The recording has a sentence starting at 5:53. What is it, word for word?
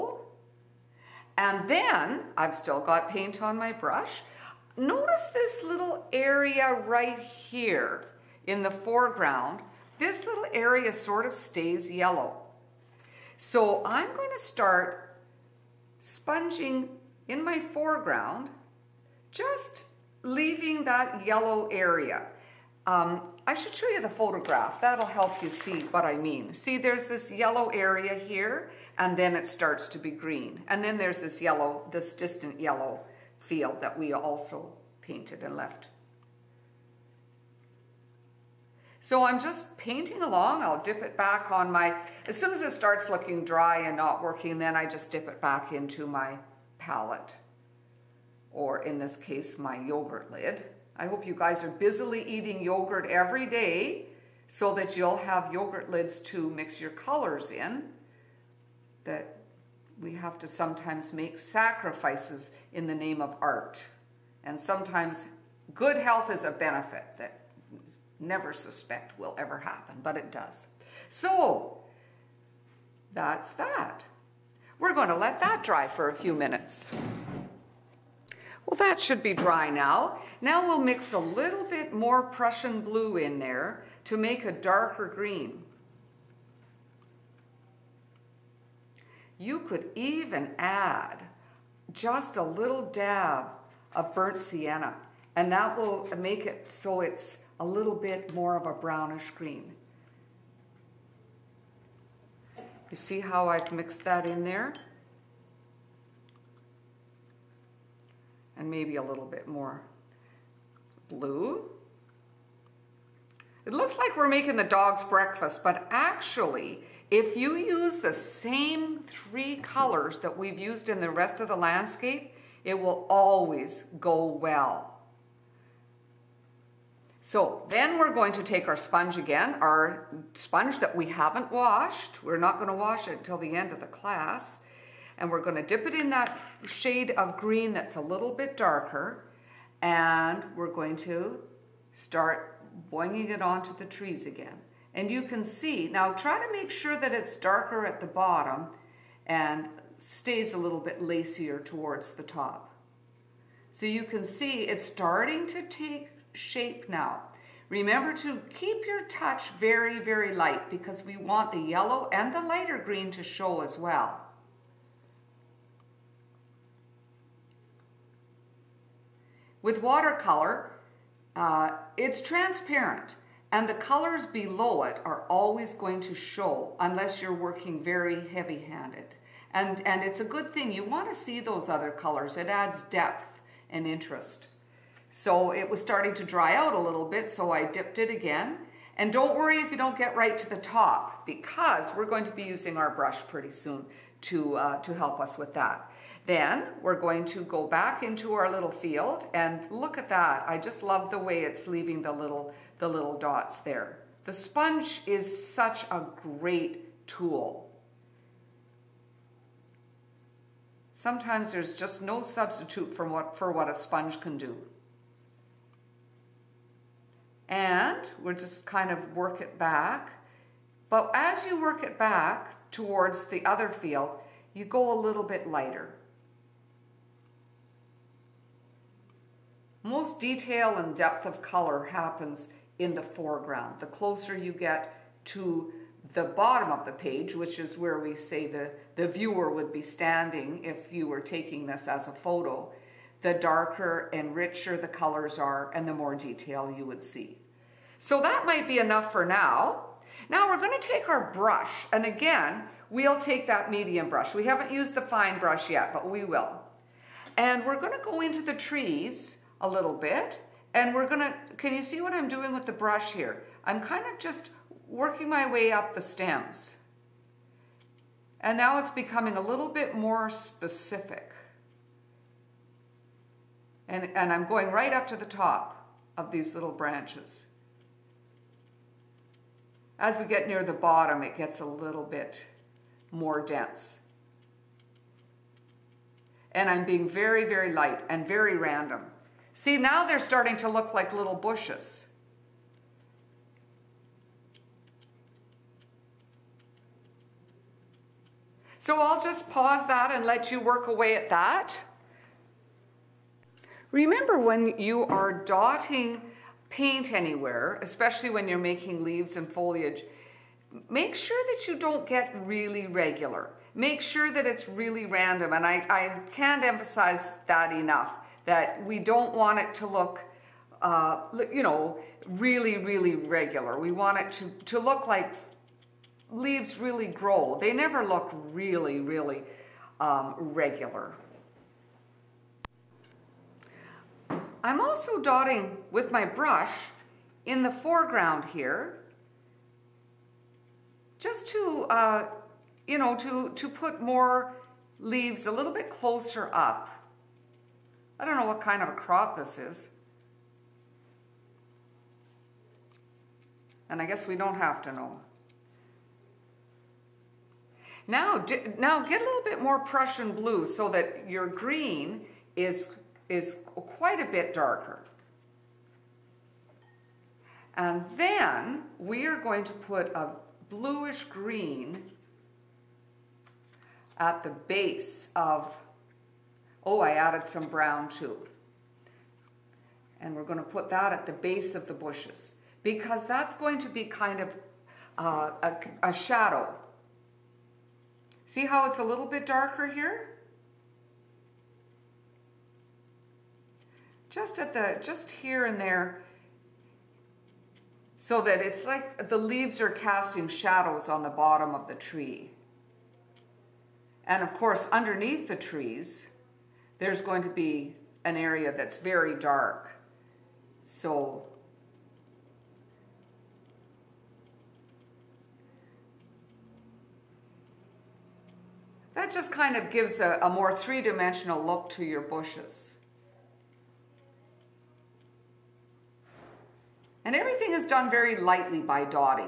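And I guess we don't have to know.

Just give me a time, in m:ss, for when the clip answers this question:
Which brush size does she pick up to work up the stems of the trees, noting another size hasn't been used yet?
4:13.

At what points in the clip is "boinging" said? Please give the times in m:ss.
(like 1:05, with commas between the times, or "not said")
2:22.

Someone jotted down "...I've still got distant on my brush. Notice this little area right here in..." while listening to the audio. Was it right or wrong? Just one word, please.
wrong.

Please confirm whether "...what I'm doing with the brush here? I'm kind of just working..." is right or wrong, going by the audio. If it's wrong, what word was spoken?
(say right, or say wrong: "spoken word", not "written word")
right.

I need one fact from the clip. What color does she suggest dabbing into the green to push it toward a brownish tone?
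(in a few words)
Burnt sienna.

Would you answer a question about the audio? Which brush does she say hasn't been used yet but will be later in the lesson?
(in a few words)
Fine brush.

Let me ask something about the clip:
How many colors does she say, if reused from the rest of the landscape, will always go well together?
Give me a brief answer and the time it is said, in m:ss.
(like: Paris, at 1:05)
3, at 1:59.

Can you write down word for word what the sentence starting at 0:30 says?
And then there's this yellow, this distant yellow field that we also painted and left.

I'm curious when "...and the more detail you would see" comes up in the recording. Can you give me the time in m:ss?
4:05.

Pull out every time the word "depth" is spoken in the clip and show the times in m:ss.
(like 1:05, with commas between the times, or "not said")
3:02, 3:50.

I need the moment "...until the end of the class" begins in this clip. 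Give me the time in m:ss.
2:13.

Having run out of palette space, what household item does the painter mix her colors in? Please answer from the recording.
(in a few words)
Yogurt lid.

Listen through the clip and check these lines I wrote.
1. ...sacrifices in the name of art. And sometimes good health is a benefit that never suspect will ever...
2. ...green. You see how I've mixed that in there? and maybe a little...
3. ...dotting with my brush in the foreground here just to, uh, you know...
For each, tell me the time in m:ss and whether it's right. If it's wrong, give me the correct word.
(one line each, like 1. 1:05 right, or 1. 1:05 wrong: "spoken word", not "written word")
1. 1:01 right
2. 1:39 right
3. 5:35 right.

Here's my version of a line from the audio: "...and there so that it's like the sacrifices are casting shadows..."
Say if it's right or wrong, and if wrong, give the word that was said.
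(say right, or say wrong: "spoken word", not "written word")
wrong: "leaves", not "sacrifices".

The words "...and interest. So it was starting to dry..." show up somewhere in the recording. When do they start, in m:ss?
3:03.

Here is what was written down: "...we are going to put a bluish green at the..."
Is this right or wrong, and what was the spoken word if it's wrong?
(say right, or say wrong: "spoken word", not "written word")
right.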